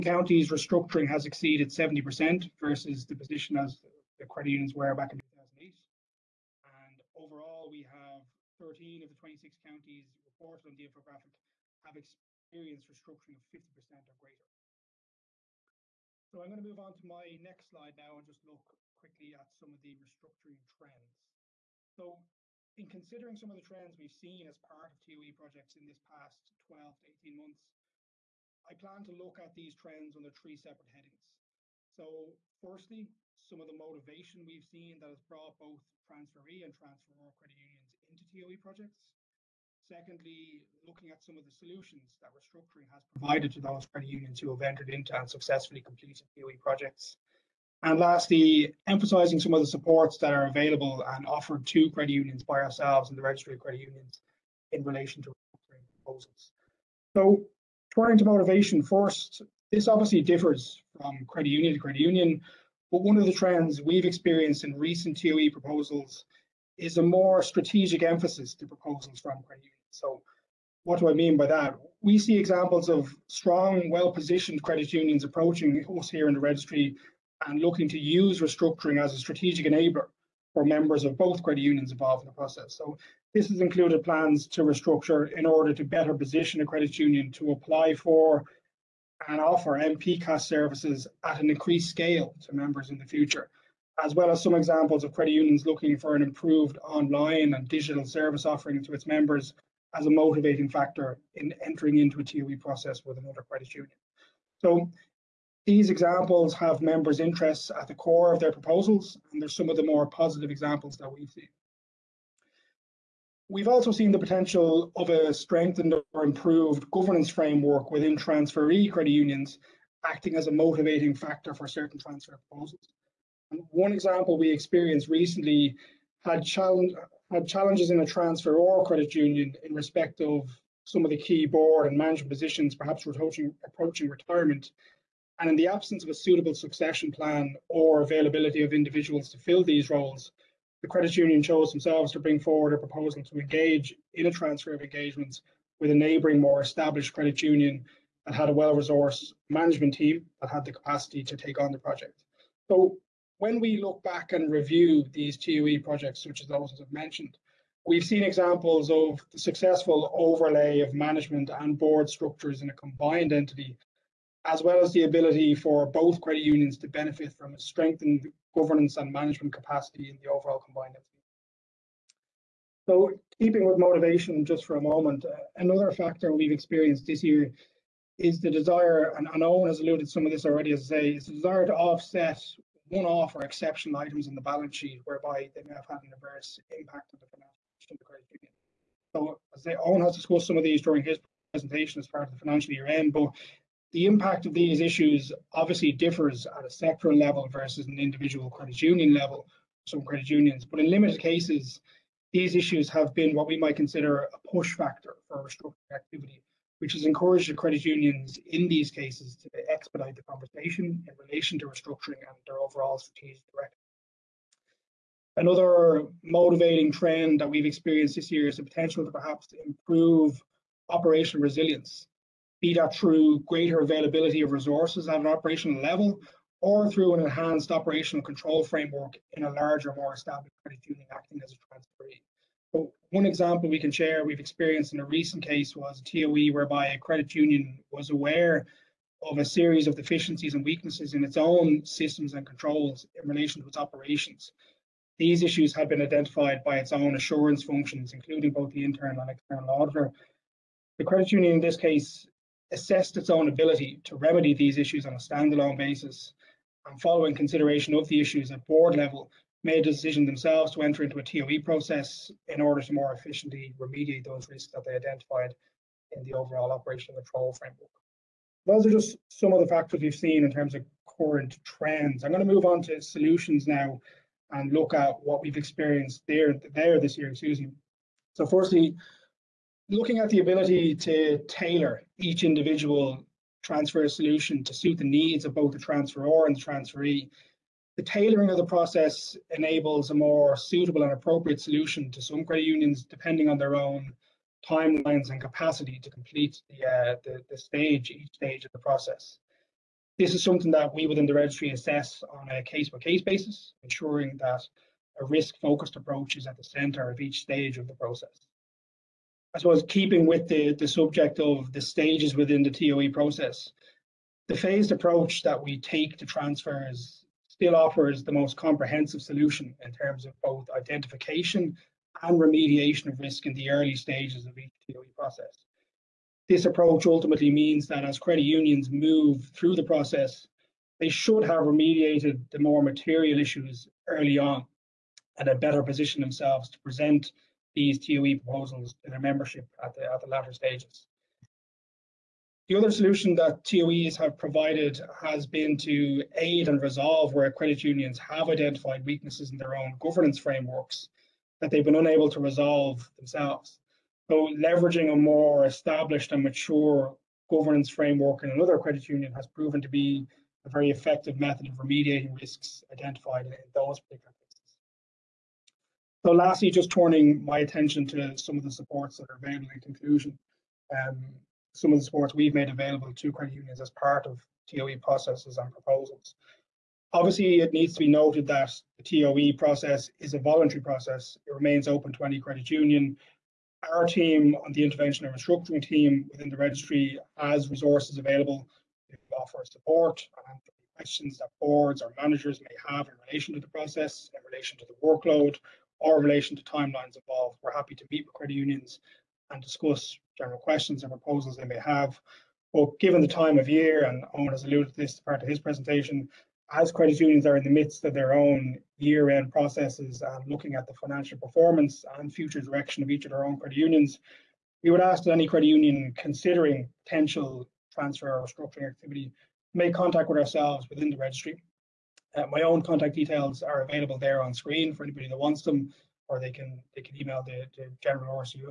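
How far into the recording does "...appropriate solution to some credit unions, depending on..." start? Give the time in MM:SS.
04:51.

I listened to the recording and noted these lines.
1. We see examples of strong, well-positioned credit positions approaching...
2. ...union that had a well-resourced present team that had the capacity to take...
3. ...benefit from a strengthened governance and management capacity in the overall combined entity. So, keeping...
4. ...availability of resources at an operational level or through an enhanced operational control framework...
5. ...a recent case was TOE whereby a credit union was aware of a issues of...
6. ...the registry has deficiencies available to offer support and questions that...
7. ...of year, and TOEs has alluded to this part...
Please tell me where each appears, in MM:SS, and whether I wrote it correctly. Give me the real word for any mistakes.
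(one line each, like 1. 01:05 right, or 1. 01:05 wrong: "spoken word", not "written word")
1. 01:12 wrong: "unions", not "positions"
2. 02:27 wrong: "management", not "present"
3. 02:46 right
4. 03:43 right
5. 03:54 wrong: "series", not "issues"
6. 06:26 wrong: "resources", not "deficiencies"
7. 06:43 wrong: "Owen", not "TOEs".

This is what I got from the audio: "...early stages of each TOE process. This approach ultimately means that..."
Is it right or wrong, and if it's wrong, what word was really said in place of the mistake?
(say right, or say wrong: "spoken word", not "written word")
right.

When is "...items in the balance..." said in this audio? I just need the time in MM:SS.
03:03.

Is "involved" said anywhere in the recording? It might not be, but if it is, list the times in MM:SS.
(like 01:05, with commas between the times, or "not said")
01:21, 06:37.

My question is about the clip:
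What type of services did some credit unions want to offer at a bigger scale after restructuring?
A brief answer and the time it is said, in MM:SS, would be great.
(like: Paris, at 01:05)
MPCAS, at 01:29.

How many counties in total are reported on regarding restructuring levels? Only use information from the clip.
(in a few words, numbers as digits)
26.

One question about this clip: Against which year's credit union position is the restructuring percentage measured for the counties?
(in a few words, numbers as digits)
2008.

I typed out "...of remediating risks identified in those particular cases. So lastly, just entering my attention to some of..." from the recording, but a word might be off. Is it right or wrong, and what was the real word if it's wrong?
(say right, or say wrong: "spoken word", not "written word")
wrong: "turning", not "entering".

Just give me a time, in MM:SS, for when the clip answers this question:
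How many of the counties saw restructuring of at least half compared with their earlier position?
00:08.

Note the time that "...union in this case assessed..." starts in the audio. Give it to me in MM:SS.
04:11.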